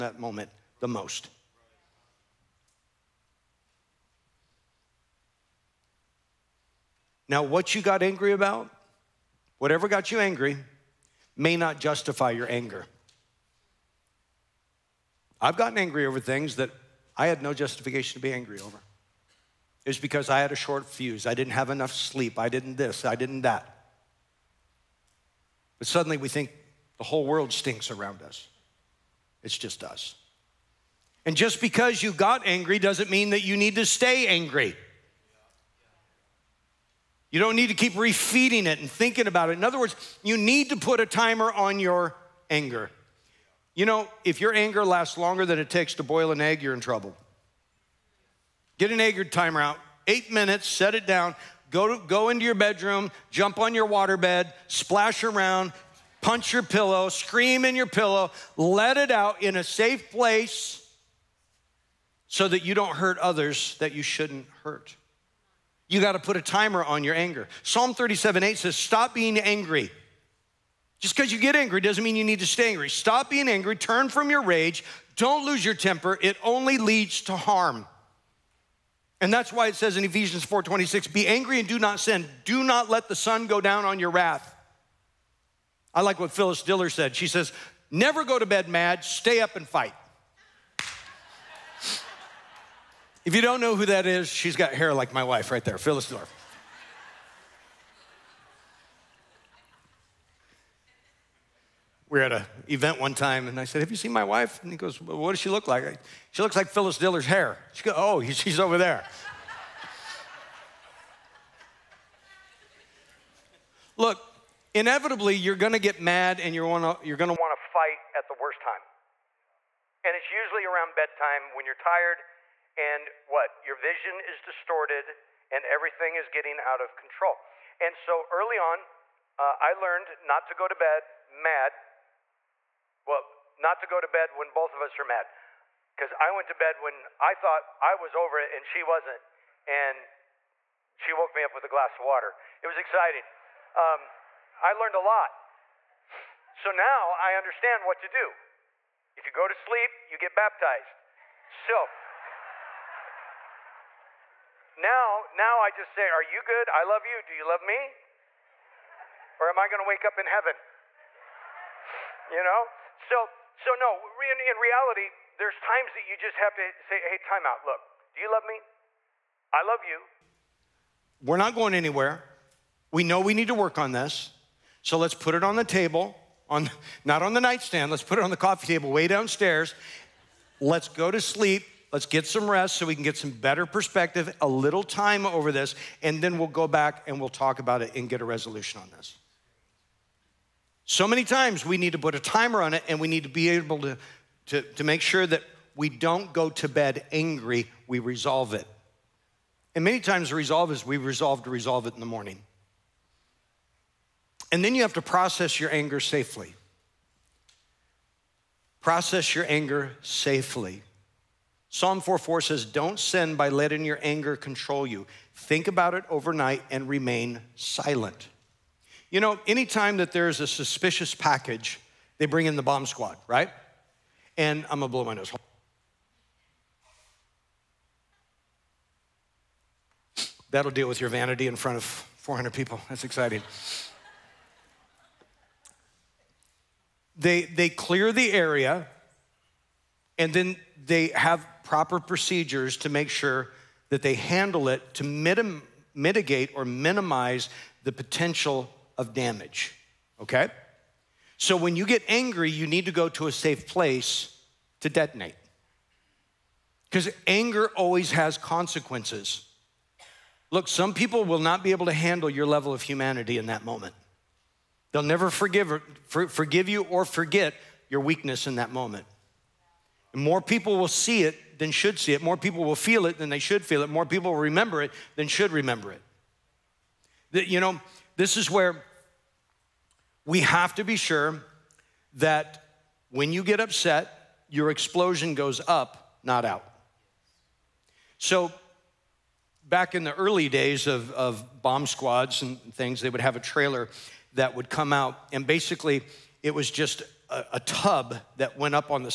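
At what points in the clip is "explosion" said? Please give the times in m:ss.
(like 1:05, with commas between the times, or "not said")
4:44.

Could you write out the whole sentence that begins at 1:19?
And that's why it says in Ephesians 4:26, be angry and do not sin.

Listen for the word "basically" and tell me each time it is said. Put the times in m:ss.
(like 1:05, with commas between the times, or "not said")
4:55.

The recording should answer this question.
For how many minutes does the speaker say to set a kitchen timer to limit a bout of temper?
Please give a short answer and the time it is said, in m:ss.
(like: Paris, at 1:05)
8, at 0:50.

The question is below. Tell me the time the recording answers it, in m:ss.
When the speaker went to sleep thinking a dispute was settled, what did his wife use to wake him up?
2:21.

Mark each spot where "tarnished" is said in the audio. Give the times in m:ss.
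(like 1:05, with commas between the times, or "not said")
not said.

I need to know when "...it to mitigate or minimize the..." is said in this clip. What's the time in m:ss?
4:04.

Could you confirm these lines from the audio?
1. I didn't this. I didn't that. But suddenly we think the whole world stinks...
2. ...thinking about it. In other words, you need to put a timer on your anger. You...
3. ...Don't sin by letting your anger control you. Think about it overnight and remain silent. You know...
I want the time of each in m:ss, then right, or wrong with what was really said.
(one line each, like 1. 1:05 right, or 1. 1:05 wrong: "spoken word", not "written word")
1. 0:22 right
2. 0:38 right
3. 3:32 right.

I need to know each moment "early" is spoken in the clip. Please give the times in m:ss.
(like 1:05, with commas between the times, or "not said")
2:08, 4:50.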